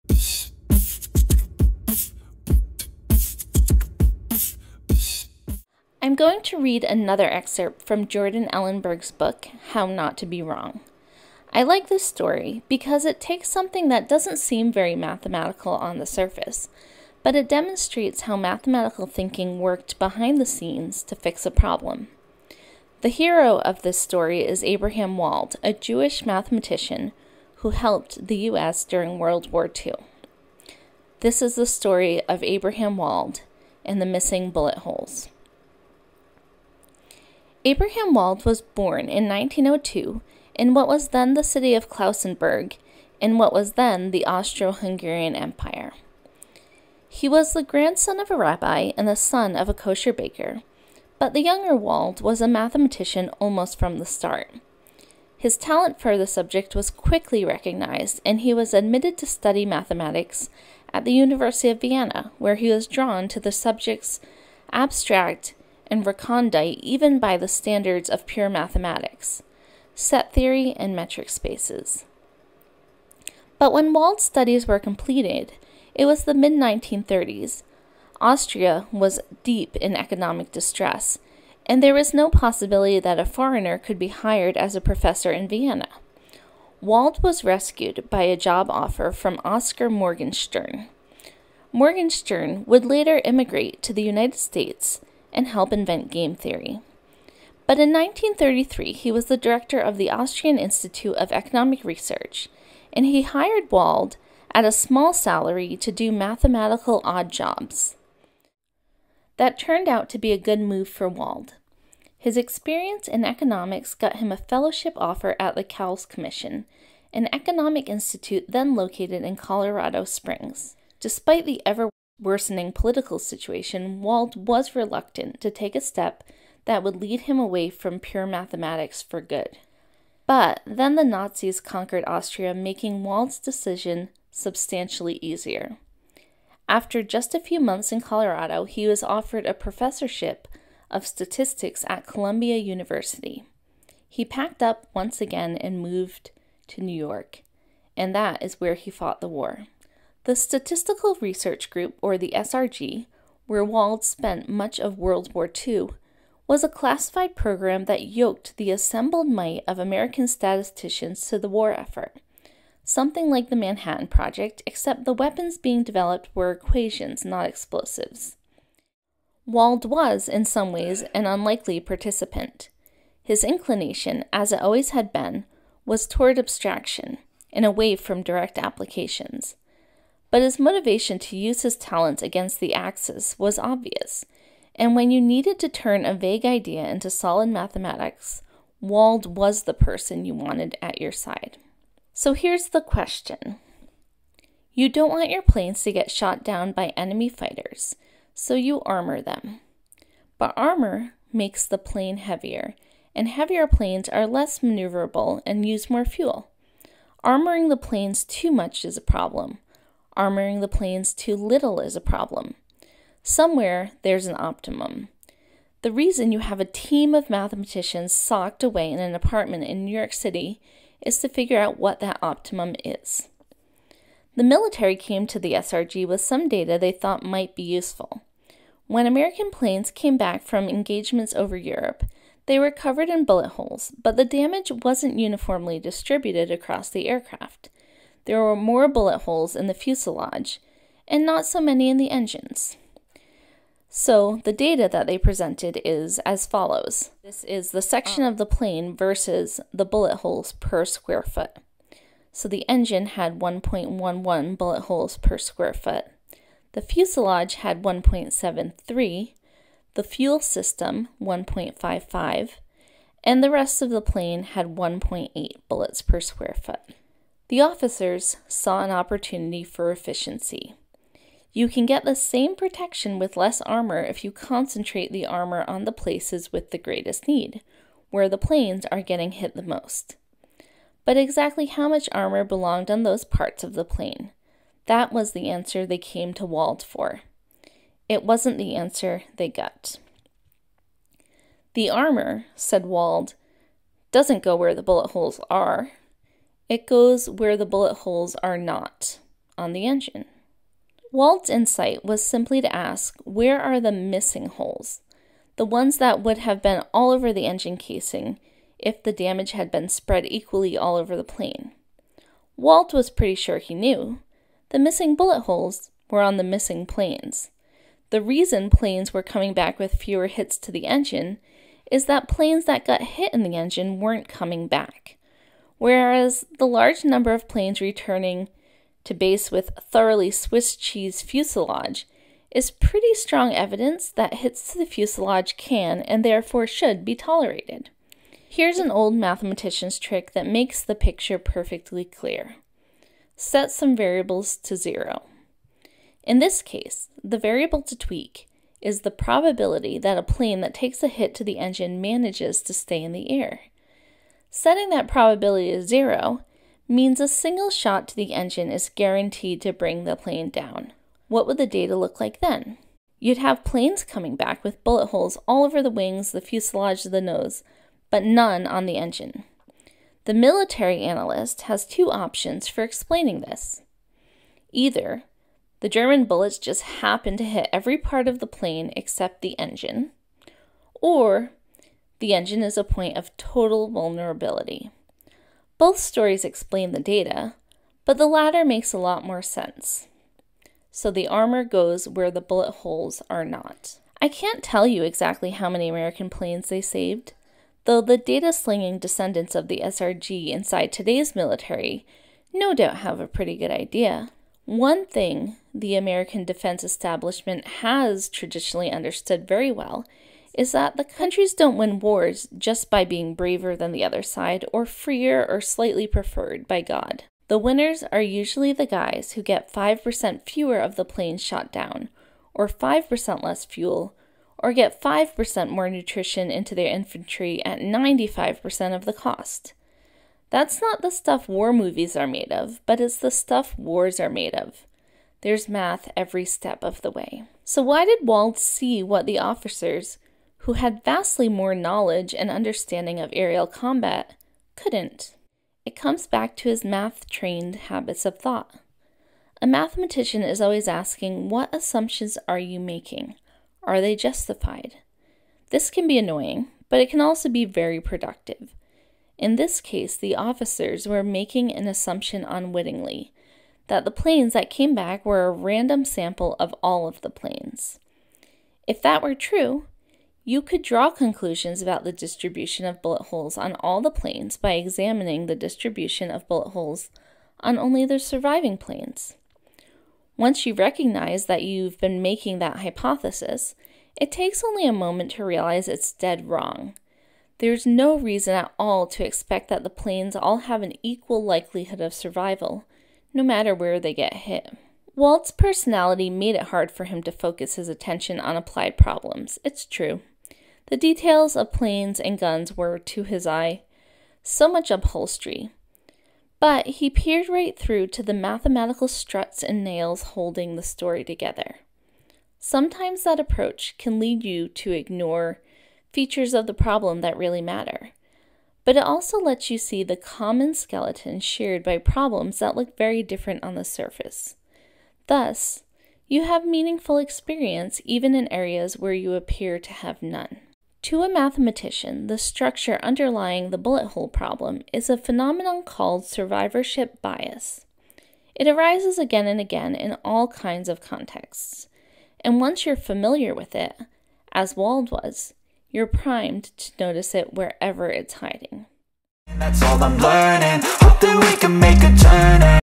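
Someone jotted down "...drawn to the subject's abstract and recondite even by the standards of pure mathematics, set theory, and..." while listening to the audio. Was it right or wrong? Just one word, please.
right.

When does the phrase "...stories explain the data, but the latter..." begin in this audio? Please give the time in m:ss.
6:25.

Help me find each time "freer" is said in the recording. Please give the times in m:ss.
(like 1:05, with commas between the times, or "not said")
6:54.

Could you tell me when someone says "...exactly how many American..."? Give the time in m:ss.
6:35.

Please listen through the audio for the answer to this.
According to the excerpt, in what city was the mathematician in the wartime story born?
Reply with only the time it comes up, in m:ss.
0:41.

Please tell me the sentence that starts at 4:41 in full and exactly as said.
But exactly how much armor belonged on those parts of the plane?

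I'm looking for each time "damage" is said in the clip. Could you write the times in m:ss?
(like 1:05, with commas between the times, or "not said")
3:54, 5:09.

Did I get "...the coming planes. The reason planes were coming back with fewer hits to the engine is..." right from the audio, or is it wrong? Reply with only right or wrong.
wrong.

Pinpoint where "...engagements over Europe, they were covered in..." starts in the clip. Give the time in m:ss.
3:50.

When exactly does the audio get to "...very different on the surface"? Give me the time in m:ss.
8:42.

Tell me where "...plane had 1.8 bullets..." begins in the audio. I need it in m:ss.
4:23.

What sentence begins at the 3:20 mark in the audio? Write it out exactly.
But armor makes the plane heavier, and heavier planes are less maneuverable and use more fuel.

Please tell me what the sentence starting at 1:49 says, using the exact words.
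That turned out to be a good move for Wald.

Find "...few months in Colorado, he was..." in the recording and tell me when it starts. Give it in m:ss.
2:17.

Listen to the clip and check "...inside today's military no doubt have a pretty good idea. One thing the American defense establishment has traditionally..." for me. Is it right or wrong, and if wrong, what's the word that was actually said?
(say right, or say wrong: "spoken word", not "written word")
right.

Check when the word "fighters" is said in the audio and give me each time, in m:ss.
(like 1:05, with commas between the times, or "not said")
3:17.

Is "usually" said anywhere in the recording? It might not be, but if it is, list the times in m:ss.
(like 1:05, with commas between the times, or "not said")
6:58.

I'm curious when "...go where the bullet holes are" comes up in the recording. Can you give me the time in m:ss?
4:54.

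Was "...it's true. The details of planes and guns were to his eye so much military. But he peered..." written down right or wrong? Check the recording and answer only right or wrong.
wrong.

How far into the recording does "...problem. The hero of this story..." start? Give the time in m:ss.
0:21.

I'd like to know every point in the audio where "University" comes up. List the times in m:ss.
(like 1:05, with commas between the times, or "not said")
1:01, 2:22.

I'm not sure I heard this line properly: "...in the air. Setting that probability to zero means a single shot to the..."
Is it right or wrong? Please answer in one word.
right.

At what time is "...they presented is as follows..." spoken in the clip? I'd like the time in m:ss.
4:05.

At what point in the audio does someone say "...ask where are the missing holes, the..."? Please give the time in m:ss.
5:02.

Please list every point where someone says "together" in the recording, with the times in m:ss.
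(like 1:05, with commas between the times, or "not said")
8:31.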